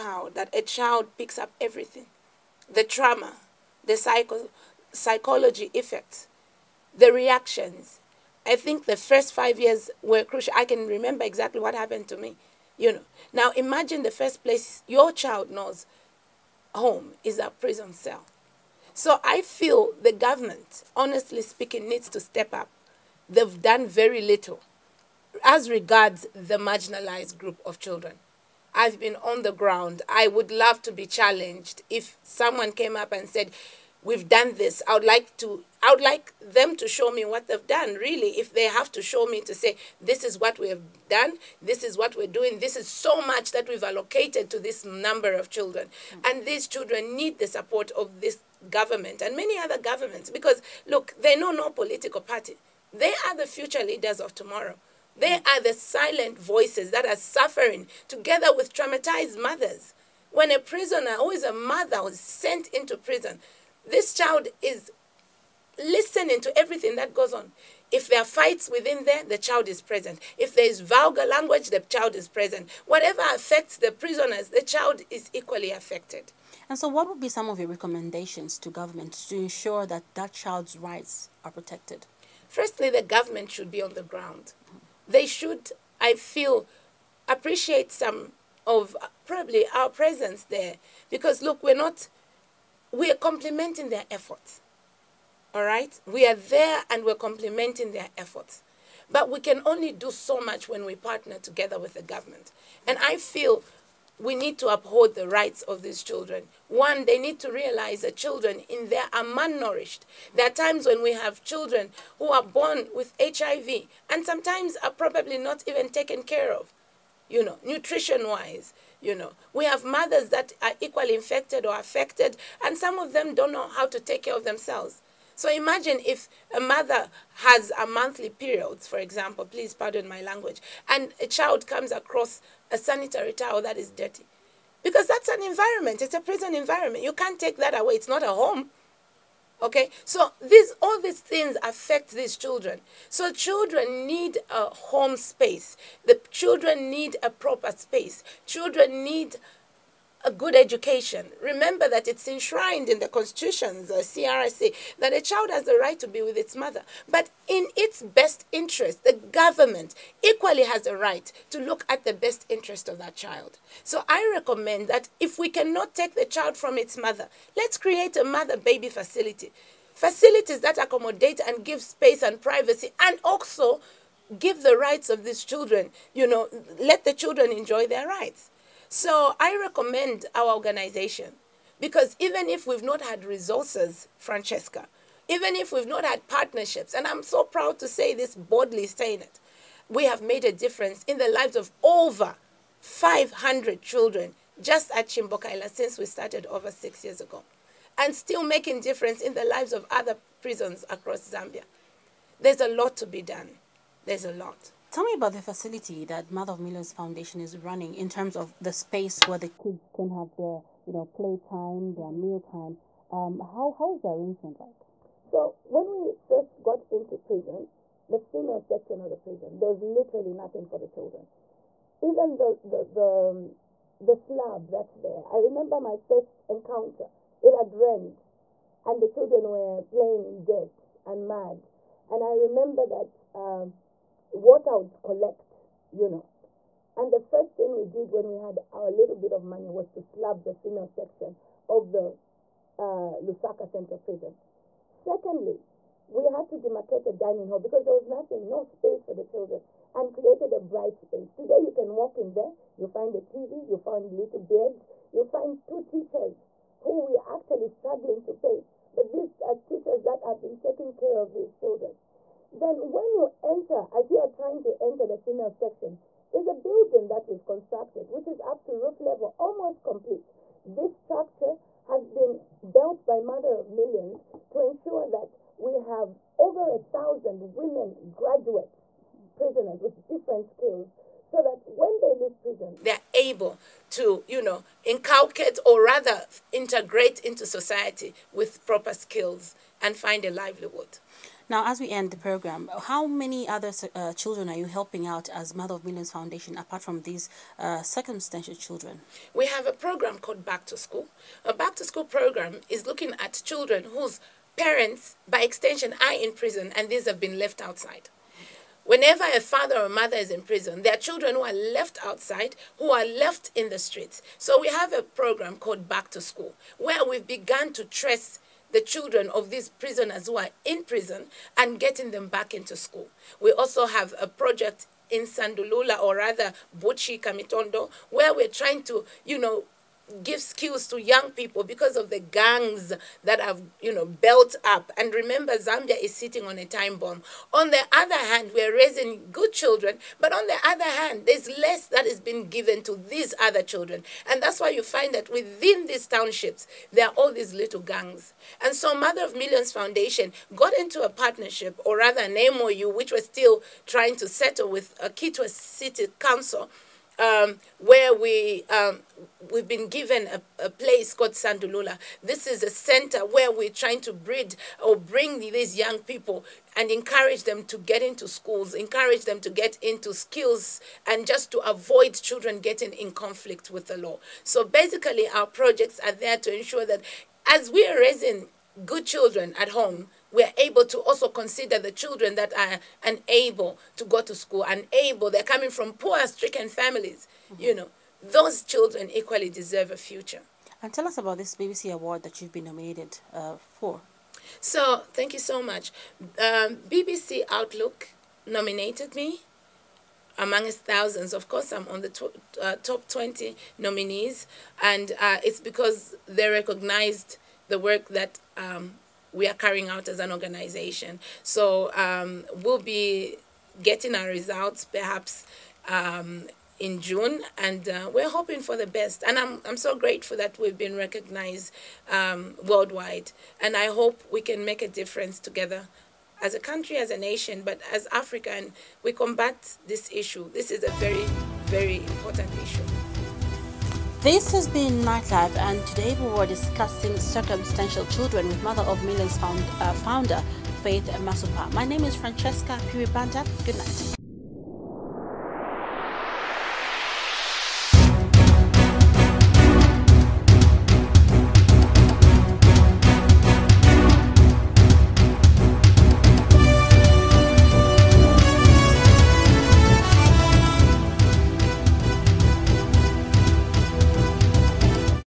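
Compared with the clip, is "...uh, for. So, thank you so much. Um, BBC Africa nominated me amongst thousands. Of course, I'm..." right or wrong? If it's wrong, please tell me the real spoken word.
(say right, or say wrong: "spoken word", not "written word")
wrong: "Outlook", not "Africa".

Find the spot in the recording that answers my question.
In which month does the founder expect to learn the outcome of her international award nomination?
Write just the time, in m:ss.
6:57.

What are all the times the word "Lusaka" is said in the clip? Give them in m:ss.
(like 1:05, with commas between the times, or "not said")
4:03.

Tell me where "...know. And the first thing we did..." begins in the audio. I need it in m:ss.
3:56.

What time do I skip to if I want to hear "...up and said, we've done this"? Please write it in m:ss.
0:32.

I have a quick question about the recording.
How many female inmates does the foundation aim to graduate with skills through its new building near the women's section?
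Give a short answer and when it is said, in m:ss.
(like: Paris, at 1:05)
over 1000, at 4:36.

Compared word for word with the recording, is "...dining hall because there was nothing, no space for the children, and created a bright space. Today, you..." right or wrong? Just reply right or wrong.
right.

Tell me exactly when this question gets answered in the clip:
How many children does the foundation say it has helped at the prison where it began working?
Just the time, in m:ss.
3:11.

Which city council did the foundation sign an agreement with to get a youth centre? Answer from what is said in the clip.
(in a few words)
Kitwe.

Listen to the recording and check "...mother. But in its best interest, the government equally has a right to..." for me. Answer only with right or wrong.
right.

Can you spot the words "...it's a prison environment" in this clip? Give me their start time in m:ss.
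2:16.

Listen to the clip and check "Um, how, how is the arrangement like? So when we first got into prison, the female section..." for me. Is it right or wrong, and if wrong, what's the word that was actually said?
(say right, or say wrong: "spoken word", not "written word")
right.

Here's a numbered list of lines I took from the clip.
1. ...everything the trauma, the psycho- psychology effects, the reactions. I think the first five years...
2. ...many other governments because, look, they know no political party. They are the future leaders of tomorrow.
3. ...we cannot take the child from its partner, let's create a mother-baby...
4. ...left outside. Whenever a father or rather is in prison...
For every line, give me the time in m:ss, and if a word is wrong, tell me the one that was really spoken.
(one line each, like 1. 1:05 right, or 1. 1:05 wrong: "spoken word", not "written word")
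1. 0:01 right
2. 0:49 right
3. 2:45 wrong: "mother", not "partner"
4. 5:07 wrong: "mother", not "rather".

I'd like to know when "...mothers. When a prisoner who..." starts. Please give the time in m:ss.
0:59.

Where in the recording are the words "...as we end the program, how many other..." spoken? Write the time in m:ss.
4:51.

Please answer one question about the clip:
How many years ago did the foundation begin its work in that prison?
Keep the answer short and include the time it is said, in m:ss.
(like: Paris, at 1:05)
over six years, at 3:16.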